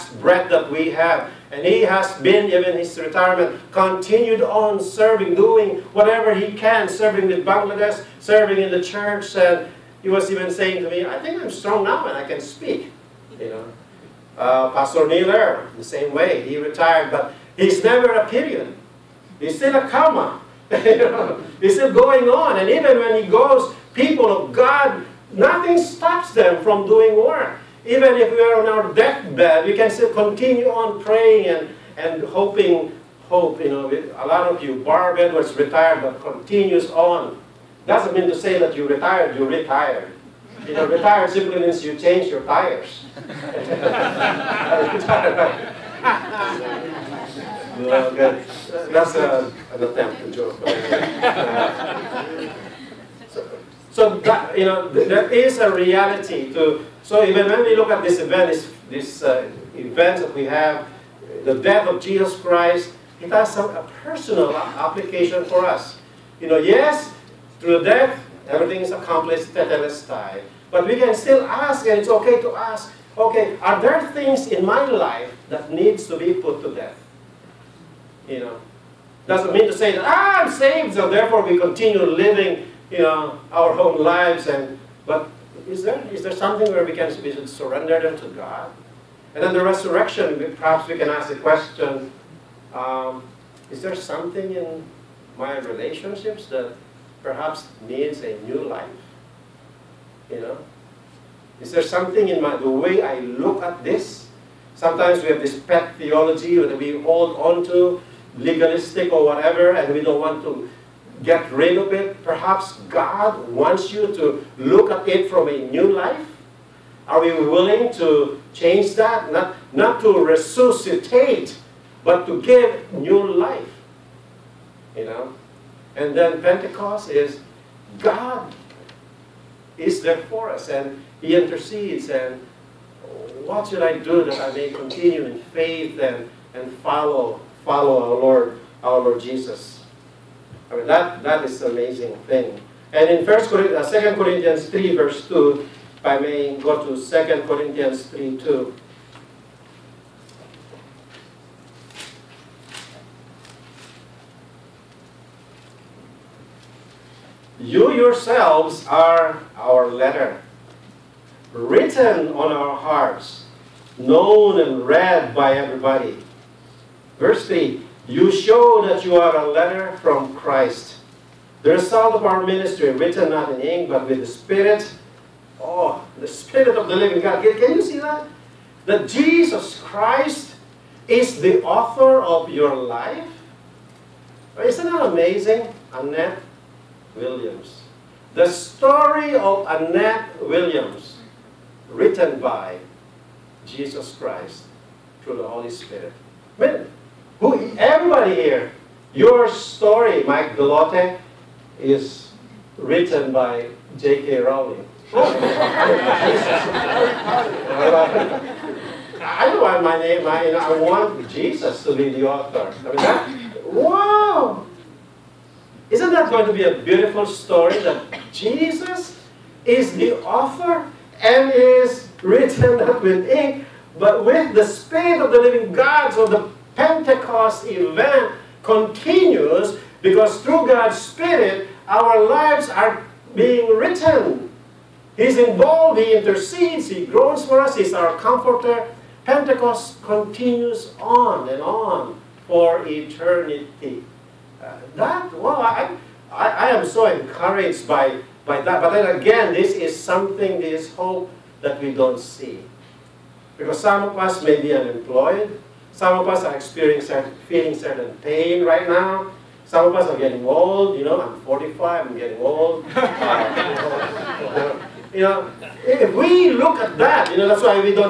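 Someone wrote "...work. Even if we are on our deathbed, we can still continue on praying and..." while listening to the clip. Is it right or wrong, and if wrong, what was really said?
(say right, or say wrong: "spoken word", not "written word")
right.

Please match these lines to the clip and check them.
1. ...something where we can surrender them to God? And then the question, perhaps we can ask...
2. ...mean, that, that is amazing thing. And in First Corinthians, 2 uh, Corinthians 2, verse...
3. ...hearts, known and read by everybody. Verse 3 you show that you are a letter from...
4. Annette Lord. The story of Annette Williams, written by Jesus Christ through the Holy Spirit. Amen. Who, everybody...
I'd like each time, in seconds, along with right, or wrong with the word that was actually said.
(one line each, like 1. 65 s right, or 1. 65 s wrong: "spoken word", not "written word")
1. 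86 s wrong: "resurrection", not "question"
2. 140 s wrong: "3", not "2"
3. 162 s right
4. 185 s wrong: "Williams", not "Lord".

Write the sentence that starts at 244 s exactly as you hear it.
Uh, that, well, I, I, I, am so encouraged by, by that.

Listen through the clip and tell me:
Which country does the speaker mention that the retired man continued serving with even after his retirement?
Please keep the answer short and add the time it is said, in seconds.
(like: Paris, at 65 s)
Bangladesh, at 7 s.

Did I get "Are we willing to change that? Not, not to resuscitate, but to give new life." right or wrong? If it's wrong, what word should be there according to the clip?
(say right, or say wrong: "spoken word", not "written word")
right.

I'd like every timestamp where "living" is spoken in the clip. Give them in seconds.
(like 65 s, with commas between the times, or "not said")
82 s, 176 s, 225 s.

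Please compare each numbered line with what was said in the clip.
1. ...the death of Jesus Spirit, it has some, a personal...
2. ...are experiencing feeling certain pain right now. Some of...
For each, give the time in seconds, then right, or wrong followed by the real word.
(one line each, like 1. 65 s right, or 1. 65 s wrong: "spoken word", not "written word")
1. 61 s wrong: "Christ", not "Spirit"
2. 256 s right.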